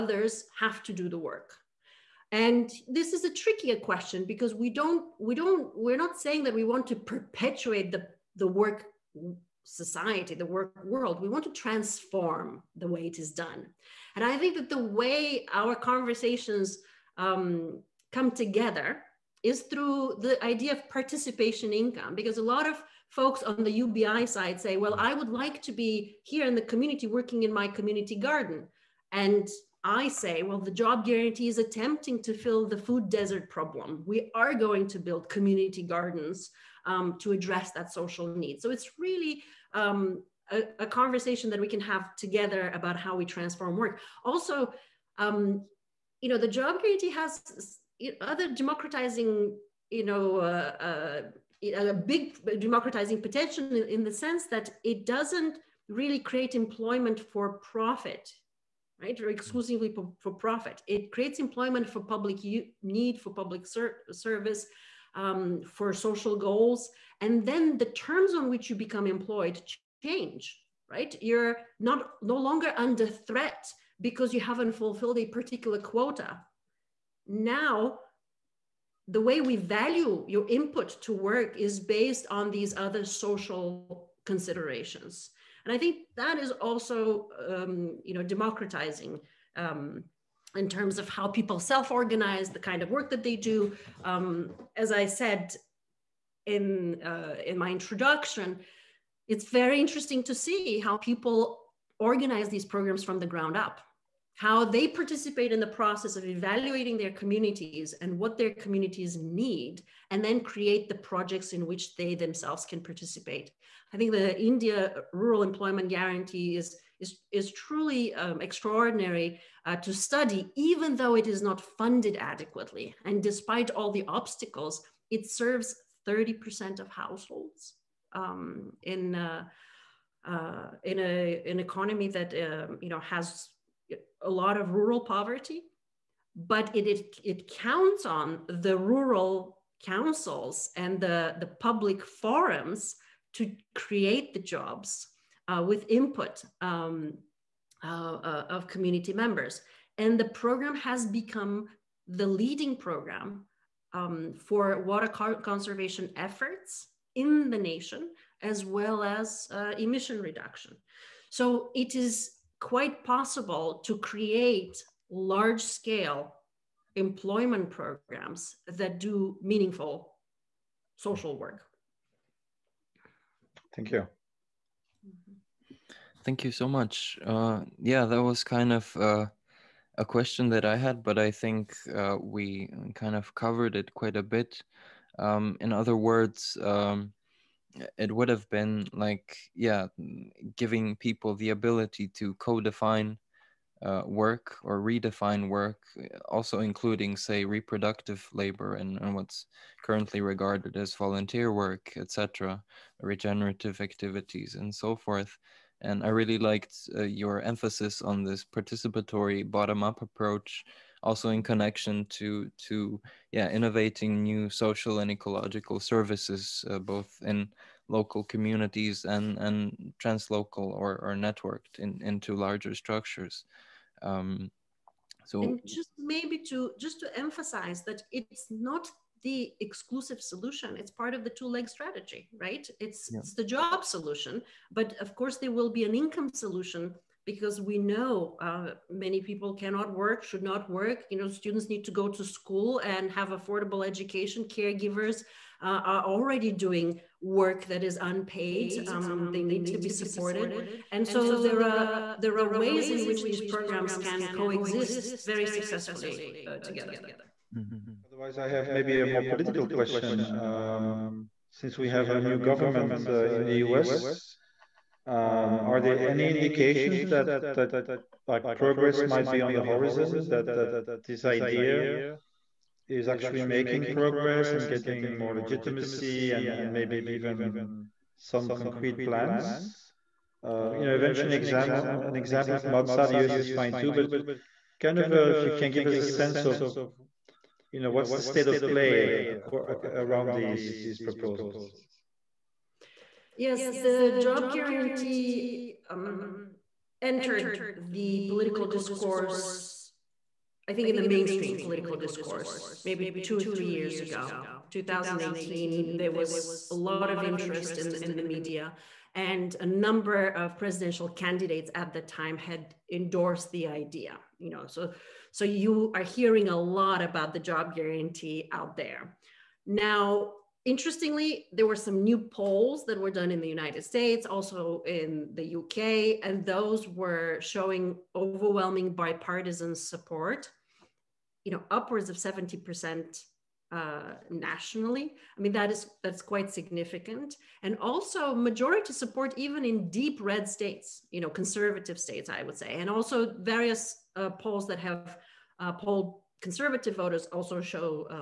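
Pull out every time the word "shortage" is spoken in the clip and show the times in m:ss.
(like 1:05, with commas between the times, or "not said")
not said.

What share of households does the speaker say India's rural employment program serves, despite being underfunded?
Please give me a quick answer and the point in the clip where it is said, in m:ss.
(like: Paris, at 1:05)
30%, at 2:06.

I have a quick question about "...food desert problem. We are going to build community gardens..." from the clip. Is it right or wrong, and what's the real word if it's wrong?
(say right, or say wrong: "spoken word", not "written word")
right.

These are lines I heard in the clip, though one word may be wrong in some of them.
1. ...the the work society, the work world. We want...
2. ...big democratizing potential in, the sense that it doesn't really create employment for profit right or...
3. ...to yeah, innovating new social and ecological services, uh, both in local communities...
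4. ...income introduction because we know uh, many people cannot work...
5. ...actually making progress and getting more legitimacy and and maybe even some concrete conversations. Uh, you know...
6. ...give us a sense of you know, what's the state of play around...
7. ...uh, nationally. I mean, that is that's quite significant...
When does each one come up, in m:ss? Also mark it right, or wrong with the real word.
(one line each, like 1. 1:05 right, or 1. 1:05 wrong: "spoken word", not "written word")
1. 0:07 right
2. 0:51 right
3. 3:32 right
4. 3:55 wrong: "solution", not "introduction"
5. 4:33 wrong: "plans", not "conversations"
6. 4:45 right
7. 5:33 right.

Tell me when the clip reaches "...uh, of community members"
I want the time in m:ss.
2:28.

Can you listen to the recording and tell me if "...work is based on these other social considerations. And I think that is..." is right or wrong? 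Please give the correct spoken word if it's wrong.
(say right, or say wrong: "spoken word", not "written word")
right.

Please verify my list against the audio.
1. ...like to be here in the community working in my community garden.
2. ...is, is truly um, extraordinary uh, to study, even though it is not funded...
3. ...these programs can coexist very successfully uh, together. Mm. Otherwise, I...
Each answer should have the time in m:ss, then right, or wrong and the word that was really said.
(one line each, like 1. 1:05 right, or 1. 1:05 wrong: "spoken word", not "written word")
1. 0:25 right
2. 1:57 right
3. 4:13 right.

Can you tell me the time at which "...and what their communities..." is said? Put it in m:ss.
1:48.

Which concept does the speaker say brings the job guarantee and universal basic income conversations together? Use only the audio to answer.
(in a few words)
participation income.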